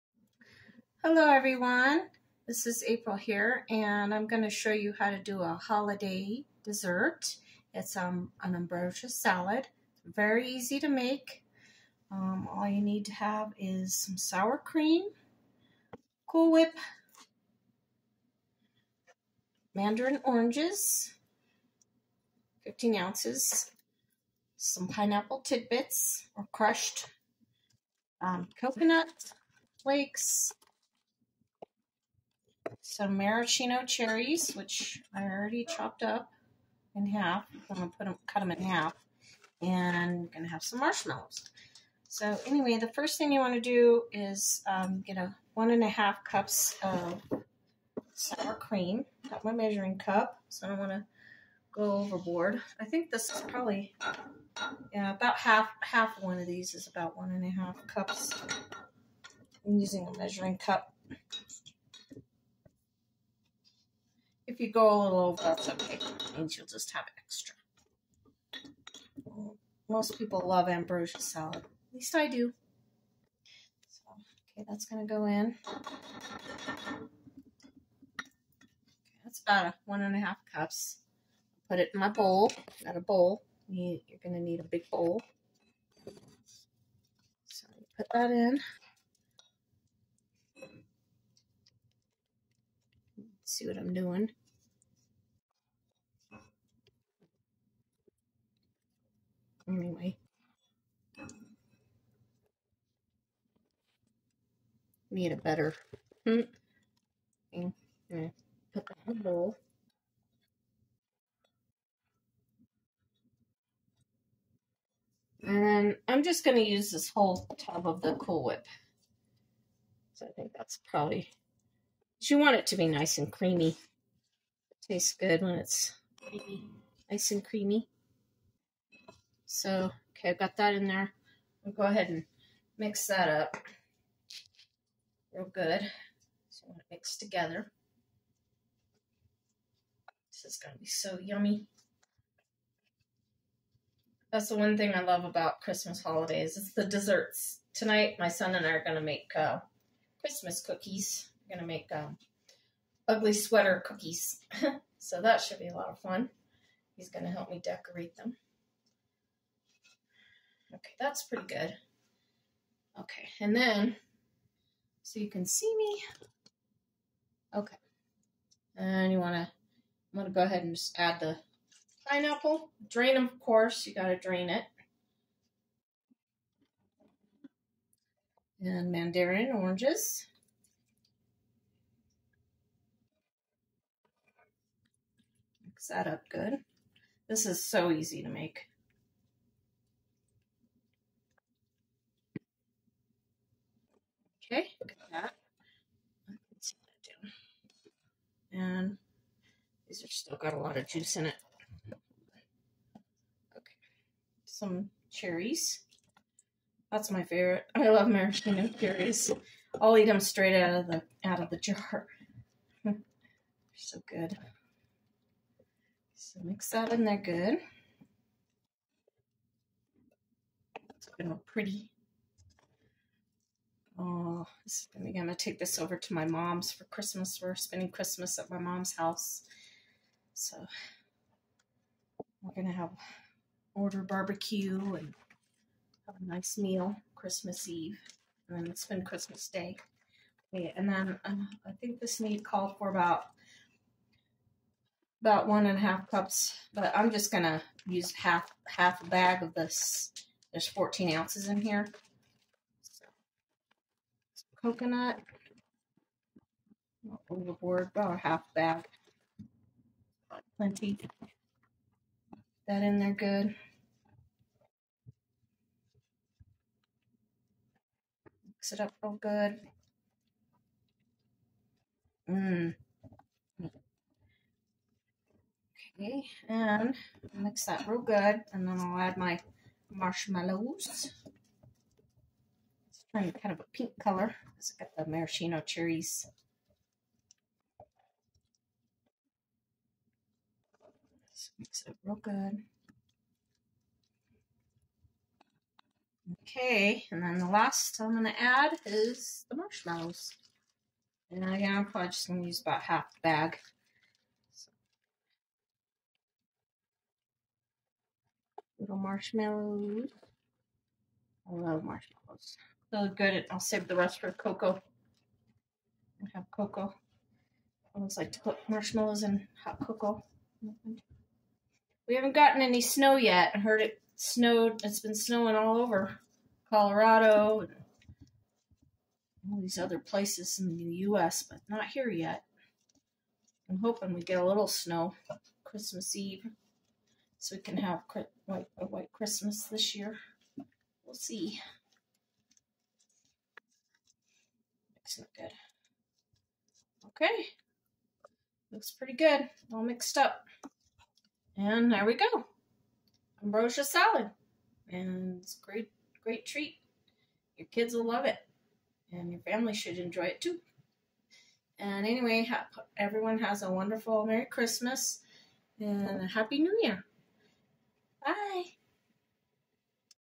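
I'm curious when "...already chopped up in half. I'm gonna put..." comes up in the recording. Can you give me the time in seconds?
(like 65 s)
35 s.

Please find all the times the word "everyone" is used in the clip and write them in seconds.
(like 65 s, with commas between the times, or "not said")
1 s, 362 s.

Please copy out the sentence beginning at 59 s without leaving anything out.
I'm using a measuring cup you go a little over, that's okay.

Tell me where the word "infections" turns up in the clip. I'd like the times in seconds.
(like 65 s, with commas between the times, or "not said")
not said.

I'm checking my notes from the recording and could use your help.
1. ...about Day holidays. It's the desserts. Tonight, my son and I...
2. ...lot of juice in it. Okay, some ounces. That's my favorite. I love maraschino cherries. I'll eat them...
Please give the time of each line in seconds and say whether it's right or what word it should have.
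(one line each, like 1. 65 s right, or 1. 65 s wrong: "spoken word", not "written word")
1. 145 s wrong: "Christmas", not "Day"
2. 200 s wrong: "cherries", not "ounces".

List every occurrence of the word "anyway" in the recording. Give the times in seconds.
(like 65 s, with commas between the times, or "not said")
42 s, 99 s, 362 s.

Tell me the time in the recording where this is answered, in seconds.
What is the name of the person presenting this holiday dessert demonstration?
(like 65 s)
2 s.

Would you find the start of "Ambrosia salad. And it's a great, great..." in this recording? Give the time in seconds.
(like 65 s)
353 s.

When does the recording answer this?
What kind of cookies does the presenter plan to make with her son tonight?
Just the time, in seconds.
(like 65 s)
153 s.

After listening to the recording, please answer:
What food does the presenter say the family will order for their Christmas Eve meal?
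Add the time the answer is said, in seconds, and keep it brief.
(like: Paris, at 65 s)
Barbecue, at 234 s.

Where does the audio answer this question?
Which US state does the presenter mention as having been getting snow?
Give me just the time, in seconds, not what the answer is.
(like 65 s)
326 s.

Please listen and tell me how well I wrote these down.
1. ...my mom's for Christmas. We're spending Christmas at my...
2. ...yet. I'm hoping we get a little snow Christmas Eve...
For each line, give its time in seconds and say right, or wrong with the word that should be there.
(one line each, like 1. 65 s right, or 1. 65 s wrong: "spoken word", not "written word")
1. 226 s right
2. 332 s right.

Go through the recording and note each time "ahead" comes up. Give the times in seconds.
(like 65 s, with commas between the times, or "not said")
131 s, 170 s.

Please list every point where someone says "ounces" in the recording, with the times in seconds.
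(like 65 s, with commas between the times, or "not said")
22 s, 251 s.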